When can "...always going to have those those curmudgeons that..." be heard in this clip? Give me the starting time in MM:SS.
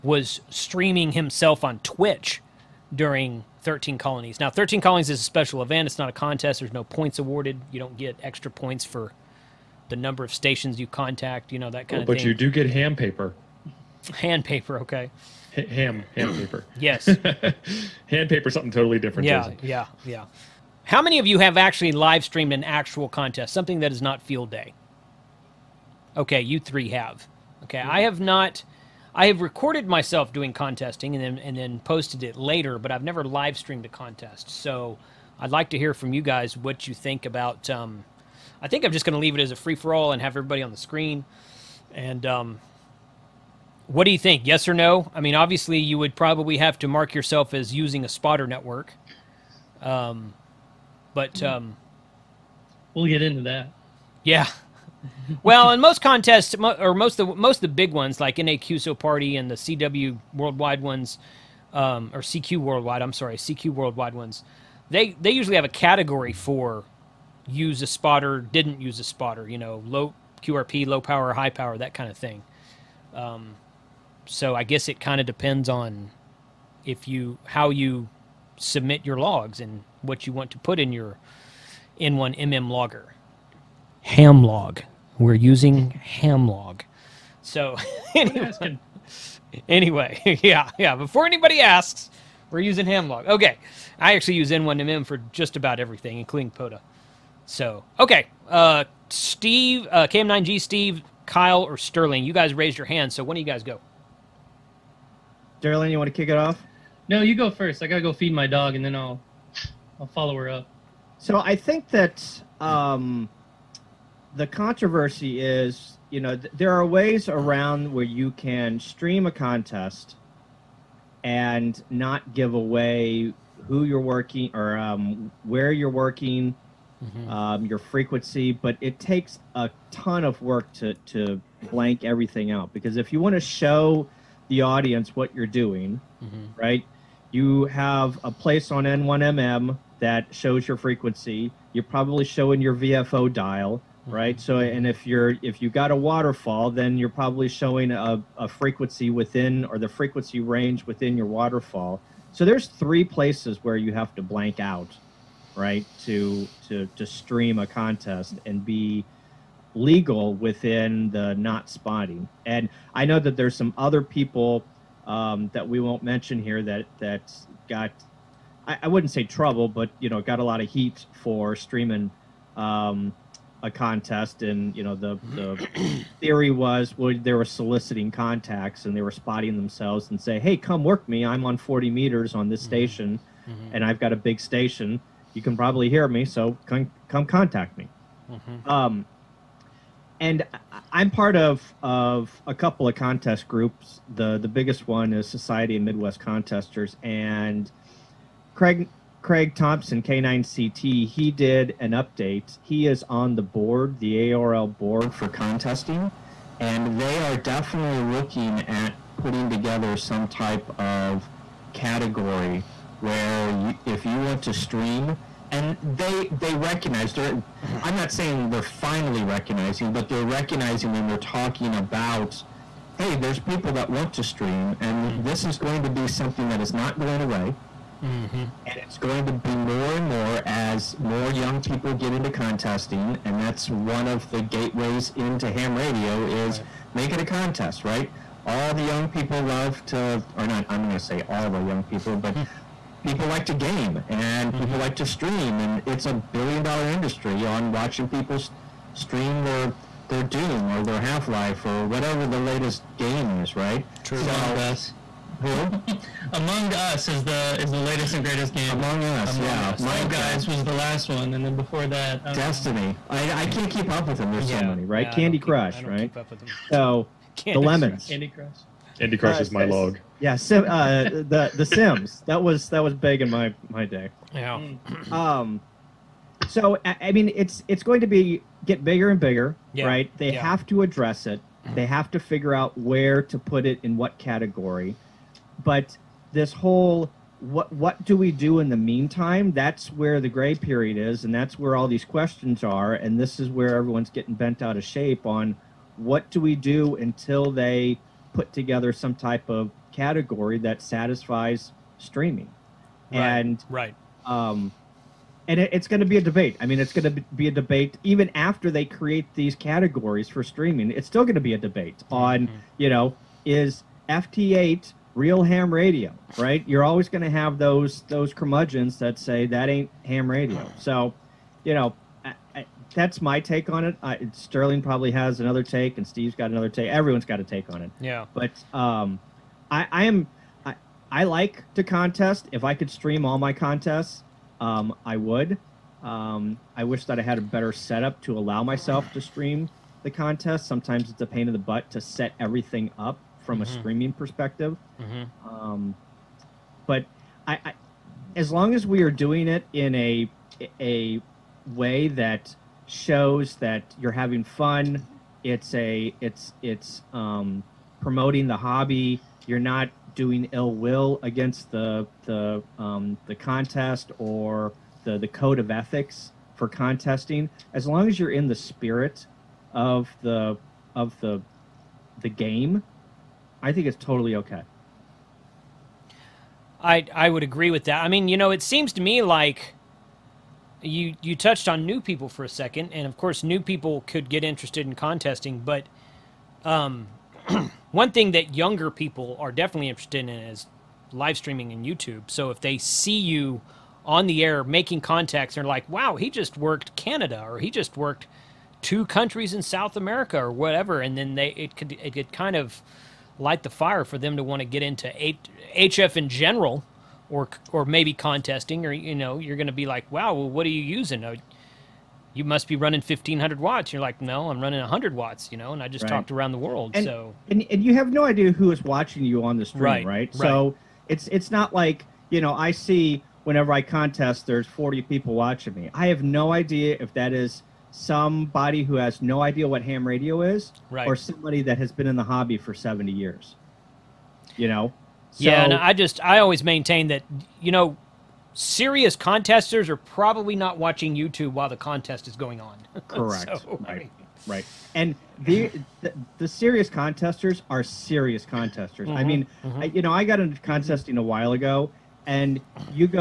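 05:16.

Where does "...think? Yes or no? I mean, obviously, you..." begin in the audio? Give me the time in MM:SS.
00:44.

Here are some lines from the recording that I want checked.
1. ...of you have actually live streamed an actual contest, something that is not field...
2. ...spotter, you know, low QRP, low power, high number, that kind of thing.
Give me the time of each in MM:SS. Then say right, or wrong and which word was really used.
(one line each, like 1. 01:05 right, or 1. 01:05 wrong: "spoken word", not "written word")
1. 00:21 right
2. 01:09 wrong: "power", not "number".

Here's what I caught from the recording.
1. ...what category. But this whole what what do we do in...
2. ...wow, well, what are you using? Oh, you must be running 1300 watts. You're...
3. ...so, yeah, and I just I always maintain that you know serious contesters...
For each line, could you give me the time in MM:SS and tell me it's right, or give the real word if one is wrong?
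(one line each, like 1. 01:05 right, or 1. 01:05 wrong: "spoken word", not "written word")
1. 04:43 right
2. 06:50 wrong: "1500", not "1300"
3. 07:15 right.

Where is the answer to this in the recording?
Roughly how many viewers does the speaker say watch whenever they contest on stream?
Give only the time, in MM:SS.
07:04.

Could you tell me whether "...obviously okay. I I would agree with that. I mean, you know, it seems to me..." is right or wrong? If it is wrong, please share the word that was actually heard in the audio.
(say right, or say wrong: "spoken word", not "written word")
wrong: "totally", not "obviously".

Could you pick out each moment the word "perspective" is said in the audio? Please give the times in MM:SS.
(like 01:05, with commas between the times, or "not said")
05:44.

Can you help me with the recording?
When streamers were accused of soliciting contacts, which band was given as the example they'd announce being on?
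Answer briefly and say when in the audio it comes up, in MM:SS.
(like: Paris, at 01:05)
40 meters, at 03:01.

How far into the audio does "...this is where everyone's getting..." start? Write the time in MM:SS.
04:53.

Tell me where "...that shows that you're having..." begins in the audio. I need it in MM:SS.
05:52.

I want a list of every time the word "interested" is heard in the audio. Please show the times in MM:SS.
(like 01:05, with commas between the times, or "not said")
06:24, 06:29.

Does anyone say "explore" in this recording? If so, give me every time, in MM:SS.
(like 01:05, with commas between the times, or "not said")
not said.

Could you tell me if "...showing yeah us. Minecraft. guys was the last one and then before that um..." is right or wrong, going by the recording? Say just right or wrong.
wrong.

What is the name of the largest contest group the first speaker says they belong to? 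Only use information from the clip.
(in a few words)
Society of Midwest Contesters.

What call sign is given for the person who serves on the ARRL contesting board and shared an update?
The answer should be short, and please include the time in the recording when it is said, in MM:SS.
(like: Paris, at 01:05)
K9CT, at 03:20.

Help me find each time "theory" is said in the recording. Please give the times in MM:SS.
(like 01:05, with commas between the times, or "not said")
02:56.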